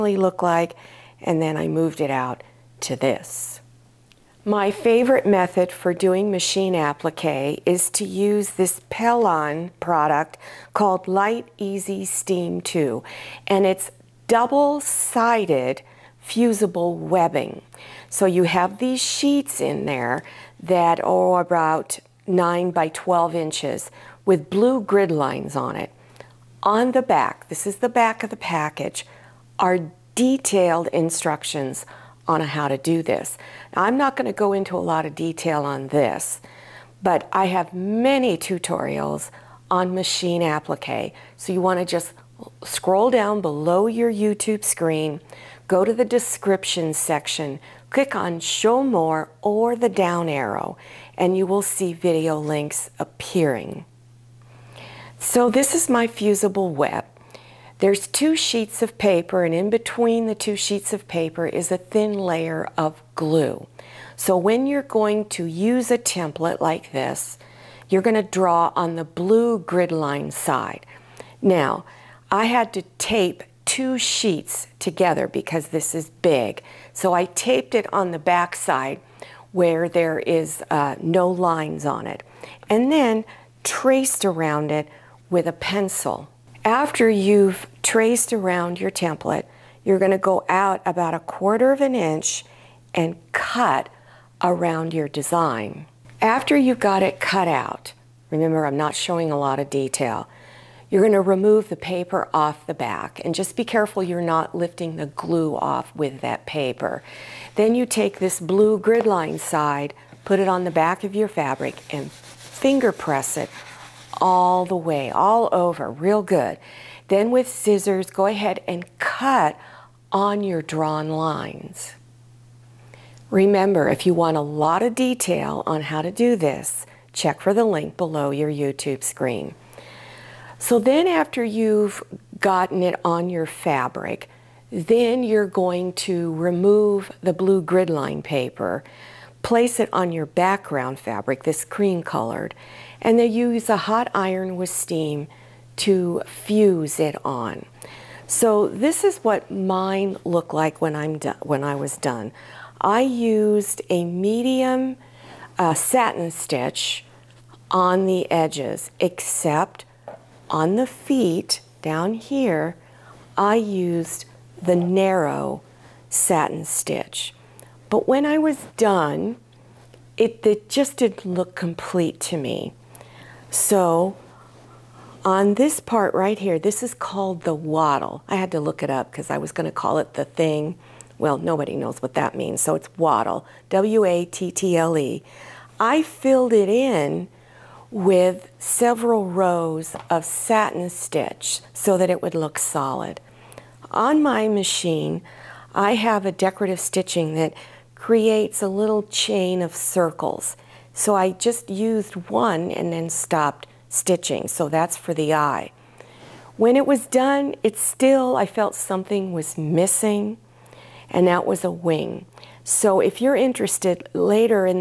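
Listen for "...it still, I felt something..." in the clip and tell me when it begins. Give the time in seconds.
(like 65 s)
207 s.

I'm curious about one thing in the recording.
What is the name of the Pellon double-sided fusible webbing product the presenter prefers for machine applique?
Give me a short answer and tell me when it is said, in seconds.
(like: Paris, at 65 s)
Light Easy Steam 2, at 11 s.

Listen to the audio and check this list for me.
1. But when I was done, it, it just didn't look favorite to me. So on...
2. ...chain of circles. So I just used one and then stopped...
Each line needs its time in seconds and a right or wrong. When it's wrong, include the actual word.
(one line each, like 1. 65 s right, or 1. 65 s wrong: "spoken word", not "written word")
1. 167 s wrong: "complete", not "favorite"
2. 199 s right.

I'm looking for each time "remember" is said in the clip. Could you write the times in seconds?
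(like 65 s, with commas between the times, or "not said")
98 s, 123 s.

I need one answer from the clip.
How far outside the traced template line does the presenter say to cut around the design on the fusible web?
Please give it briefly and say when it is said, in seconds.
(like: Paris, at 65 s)
a quarter of an inch, at 91 s.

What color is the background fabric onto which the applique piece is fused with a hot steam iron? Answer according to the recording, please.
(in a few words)
cream.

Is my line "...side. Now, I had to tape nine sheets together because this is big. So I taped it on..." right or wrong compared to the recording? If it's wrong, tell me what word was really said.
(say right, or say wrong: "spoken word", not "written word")
wrong: "two", not "nine".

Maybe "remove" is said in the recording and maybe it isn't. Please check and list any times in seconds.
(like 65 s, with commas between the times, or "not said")
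101 s, 136 s.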